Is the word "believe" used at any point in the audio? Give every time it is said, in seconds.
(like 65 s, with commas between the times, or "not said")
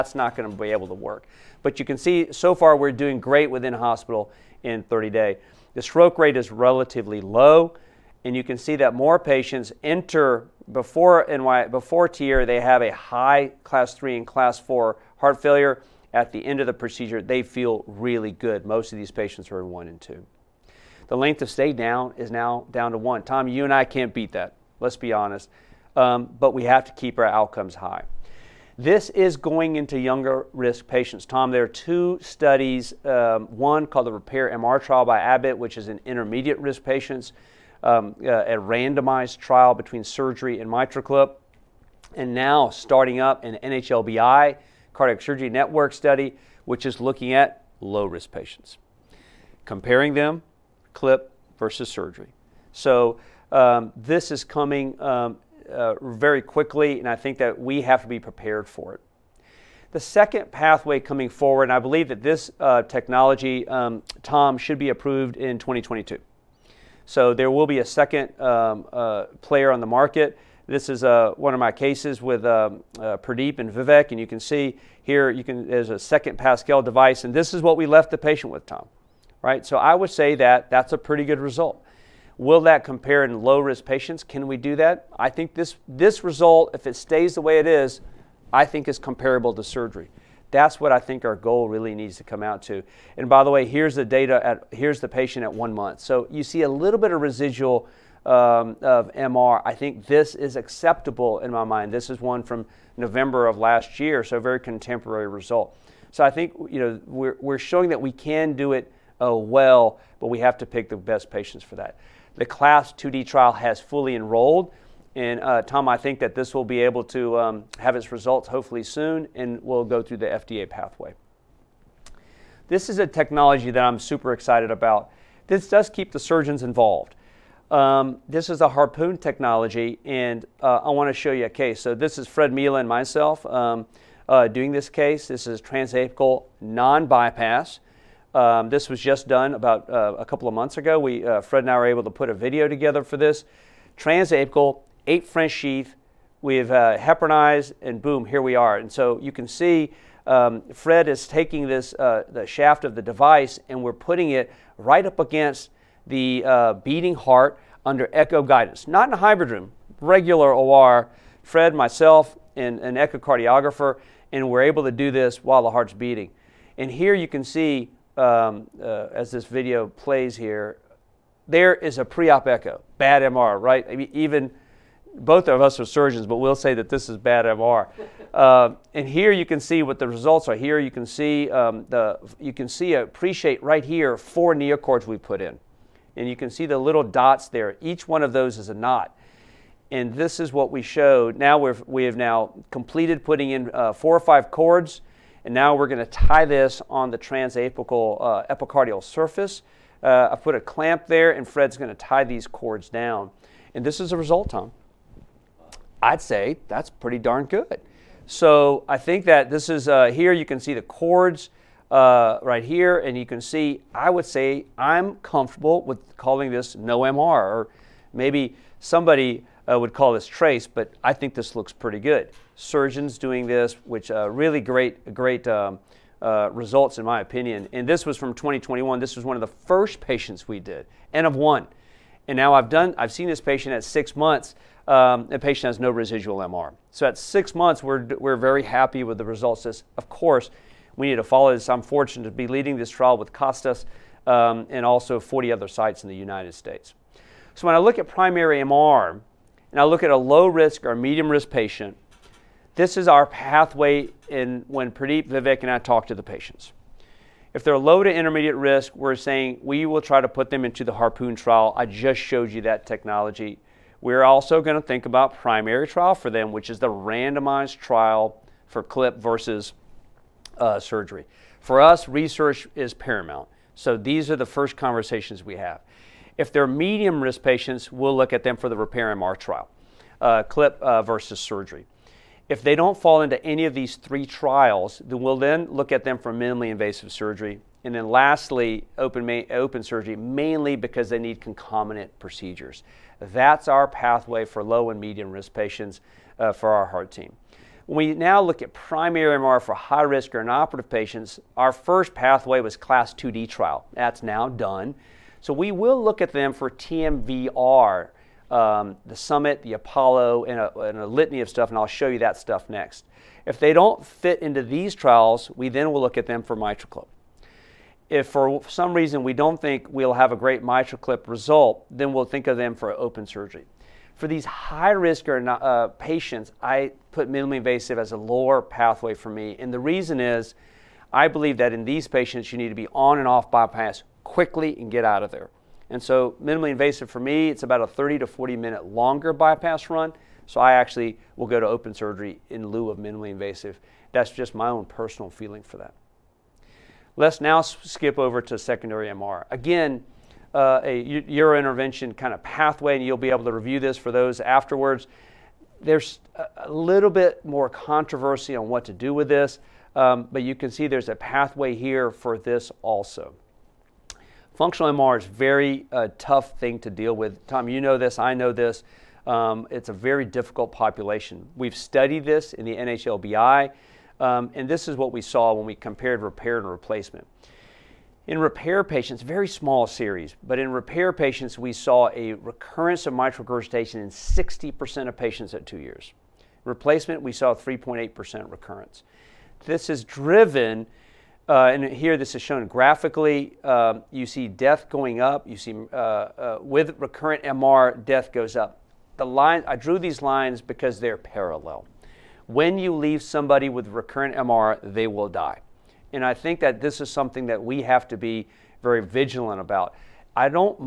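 61 s, 331 s.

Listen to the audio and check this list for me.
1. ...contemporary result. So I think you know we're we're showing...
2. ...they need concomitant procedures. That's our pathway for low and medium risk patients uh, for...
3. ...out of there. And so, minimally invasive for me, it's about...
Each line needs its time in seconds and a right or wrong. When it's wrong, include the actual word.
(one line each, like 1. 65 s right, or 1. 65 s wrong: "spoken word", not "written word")
1. 104 s right
2. 291 s right
3. 335 s right.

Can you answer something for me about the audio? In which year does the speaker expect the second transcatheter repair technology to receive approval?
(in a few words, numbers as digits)
2022.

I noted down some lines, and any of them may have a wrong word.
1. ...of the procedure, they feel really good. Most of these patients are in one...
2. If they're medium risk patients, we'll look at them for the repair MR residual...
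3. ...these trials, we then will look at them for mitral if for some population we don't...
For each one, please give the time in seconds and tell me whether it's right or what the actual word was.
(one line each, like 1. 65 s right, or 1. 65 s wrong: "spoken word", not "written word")
1. 16 s right
2. 276 s wrong: "trial", not "residual"
3. 314 s wrong: "reason", not "population".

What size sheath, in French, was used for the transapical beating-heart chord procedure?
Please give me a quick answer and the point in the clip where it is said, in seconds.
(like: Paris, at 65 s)
8 French, at 145 s.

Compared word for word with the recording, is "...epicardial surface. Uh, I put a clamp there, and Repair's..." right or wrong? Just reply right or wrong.
wrong.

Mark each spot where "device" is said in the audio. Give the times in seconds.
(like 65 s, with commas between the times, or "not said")
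76 s, 153 s.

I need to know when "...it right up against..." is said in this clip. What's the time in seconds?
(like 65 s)
154 s.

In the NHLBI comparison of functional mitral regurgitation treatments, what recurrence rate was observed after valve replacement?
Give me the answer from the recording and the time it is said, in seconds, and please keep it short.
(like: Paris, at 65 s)
3.8%, at 387 s.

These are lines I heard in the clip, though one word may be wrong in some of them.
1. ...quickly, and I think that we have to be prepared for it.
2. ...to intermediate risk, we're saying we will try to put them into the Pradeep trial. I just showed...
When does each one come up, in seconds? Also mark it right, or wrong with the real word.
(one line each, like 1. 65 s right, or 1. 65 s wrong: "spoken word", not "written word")
1. 56 s right
2. 258 s wrong: "Harpoon", not "Pradeep".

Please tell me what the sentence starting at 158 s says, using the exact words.
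Not in a hybrid room, regular OR.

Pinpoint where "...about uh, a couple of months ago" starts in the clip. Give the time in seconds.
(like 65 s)
139 s.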